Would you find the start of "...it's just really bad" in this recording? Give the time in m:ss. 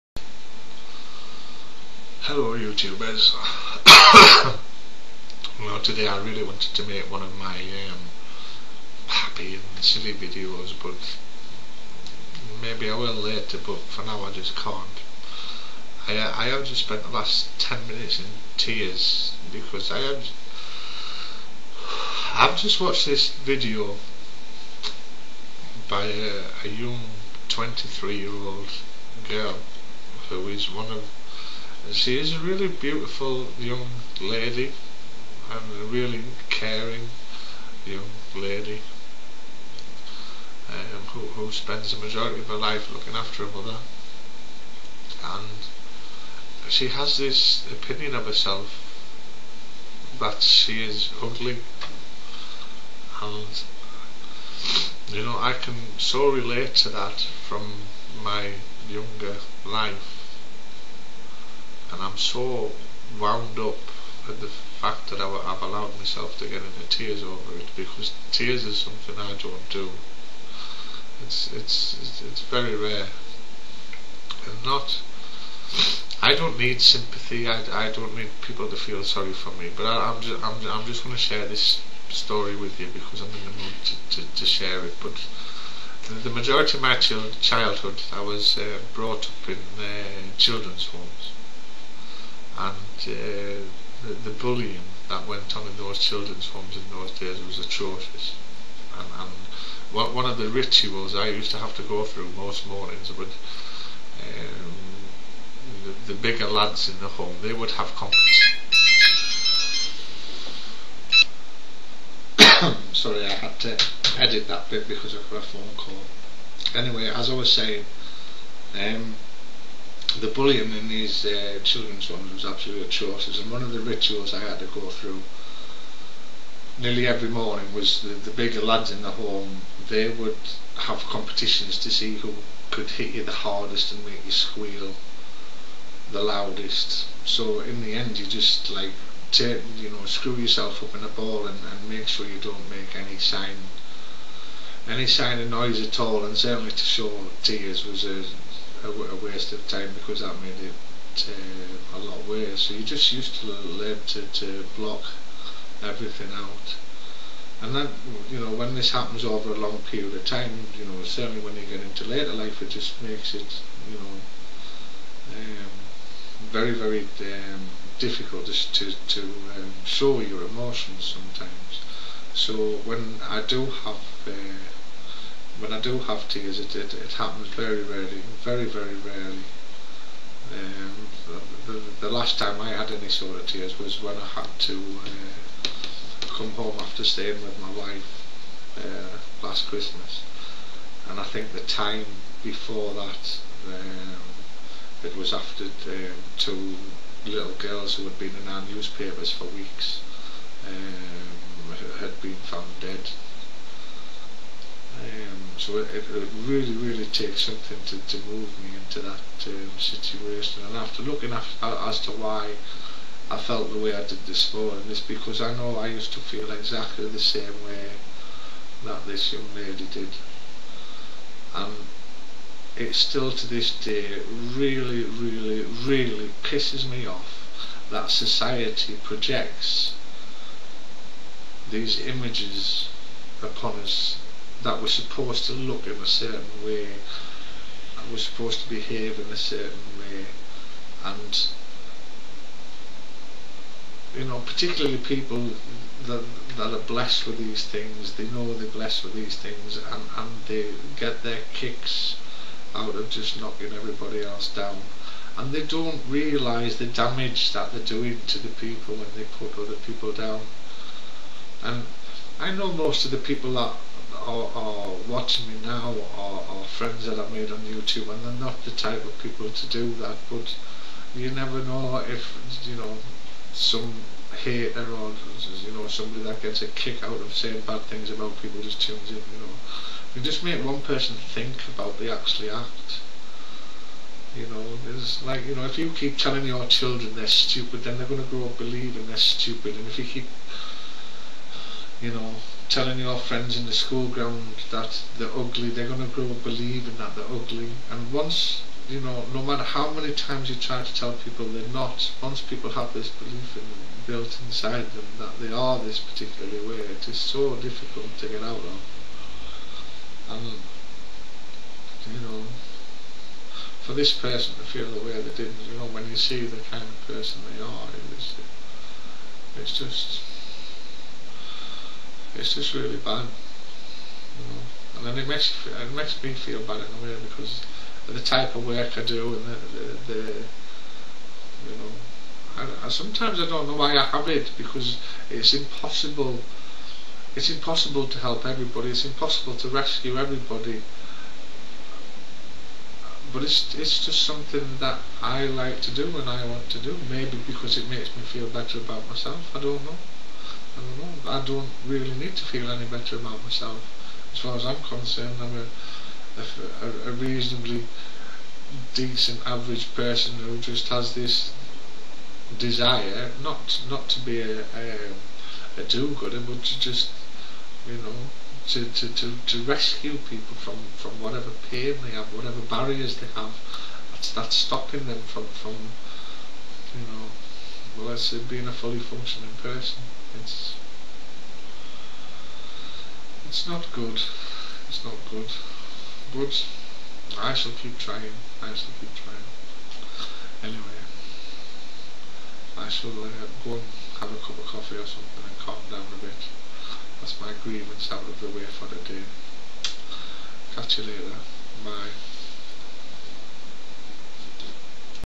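5:22.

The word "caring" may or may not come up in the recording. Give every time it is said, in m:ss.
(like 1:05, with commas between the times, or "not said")
0:36.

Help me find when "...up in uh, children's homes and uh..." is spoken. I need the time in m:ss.
1:29.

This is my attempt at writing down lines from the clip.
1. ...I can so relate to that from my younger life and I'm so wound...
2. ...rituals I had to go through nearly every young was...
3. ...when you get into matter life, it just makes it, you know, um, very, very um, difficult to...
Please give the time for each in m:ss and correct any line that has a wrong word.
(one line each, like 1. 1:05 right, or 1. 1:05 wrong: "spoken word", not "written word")
1. 0:55 right
2. 2:03 wrong: "morning", not "young"
3. 2:41 wrong: "later", not "matter".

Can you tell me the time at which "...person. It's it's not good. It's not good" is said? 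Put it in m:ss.
6:19.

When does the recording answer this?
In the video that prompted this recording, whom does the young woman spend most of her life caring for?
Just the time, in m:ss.
0:43.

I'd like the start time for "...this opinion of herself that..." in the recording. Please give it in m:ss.
0:47.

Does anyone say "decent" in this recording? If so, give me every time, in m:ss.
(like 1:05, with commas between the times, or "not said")
5:58.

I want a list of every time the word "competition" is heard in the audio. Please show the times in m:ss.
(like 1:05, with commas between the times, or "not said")
1:47, 2:11.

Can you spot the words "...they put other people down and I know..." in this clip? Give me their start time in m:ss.
4:19.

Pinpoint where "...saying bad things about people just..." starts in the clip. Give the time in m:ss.
4:37.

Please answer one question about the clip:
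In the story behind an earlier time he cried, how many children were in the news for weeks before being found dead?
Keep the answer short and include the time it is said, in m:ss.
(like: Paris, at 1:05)
2, at 3:16.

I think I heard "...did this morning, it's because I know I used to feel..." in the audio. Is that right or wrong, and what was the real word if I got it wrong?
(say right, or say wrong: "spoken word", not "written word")
right.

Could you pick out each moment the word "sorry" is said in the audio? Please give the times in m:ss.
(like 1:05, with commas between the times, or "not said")
1:19, 1:52.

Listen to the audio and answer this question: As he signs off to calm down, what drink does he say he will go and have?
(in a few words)
Coffee.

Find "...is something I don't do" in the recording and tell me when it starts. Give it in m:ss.
1:08.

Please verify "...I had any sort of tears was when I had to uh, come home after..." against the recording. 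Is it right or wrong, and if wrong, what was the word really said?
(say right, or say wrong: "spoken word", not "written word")
right.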